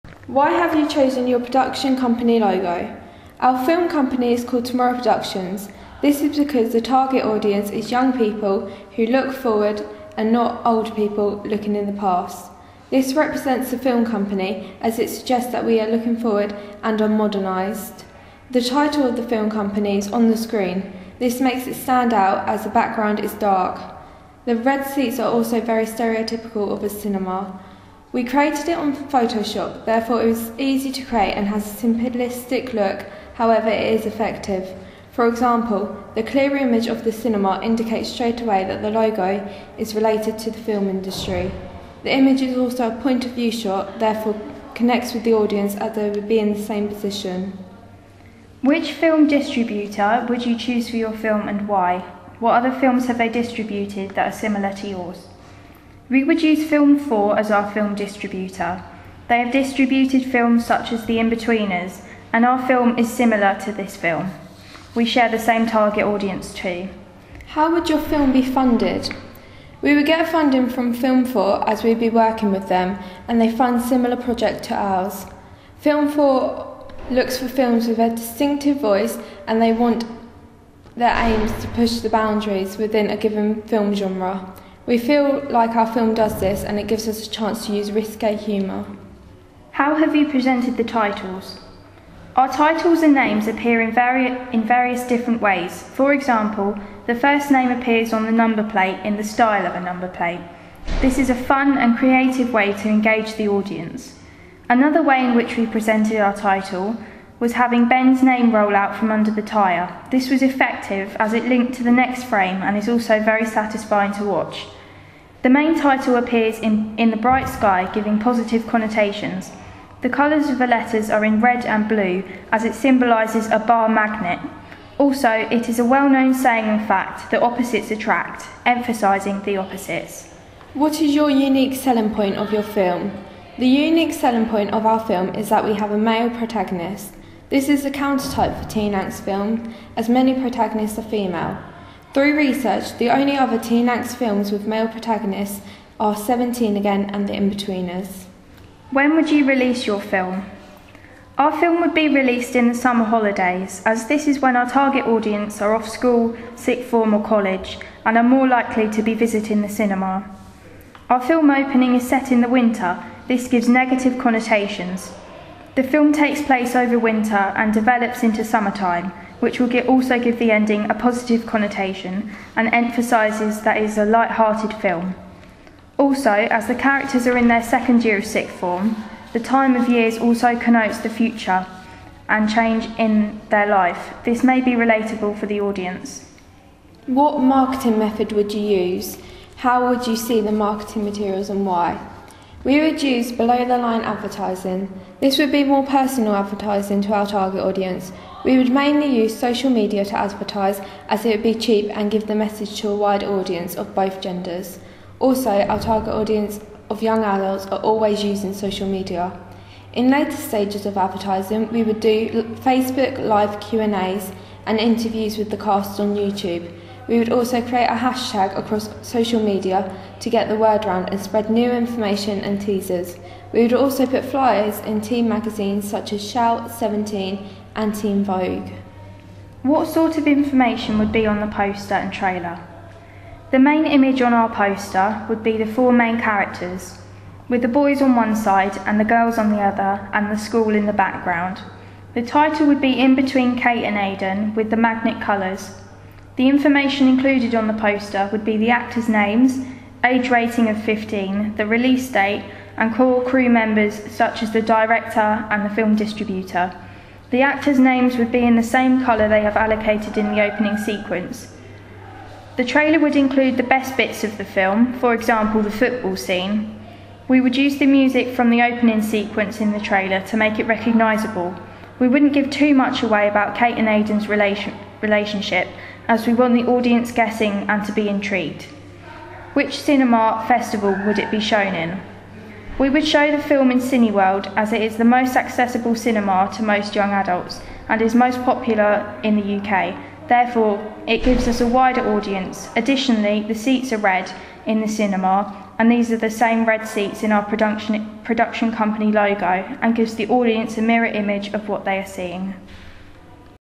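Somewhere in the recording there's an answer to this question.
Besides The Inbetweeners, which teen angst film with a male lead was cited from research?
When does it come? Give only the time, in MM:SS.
02:26.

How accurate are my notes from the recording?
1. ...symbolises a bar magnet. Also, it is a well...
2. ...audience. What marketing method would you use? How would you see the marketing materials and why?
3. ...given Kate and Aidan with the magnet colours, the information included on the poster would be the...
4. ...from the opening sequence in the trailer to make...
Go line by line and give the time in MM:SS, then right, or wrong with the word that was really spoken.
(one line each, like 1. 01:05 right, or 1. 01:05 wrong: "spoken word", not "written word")
1. 02:02 right
2. 03:05 right
3. 04:03 wrong: "between", not "given"
4. 04:28 right.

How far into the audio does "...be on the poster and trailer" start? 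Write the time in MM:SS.
03:51.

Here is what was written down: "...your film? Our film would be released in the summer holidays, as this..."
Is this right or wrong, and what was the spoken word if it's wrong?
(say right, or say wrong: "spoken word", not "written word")
right.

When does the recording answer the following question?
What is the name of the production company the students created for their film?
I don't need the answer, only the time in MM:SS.
00:04.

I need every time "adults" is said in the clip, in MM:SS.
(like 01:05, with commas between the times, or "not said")
03:27, 04:47.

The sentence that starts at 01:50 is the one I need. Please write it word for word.
This was effective as it linked to the next frame and is also very satisfying to watch.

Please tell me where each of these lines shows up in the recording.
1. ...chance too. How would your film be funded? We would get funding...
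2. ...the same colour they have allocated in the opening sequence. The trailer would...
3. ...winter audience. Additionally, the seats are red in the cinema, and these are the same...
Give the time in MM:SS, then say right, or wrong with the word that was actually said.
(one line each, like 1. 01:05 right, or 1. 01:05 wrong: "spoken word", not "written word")
1. 01:06 wrong: "audience", not "chance"
2. 04:18 right
3. 04:51 wrong: "wider", not "winter".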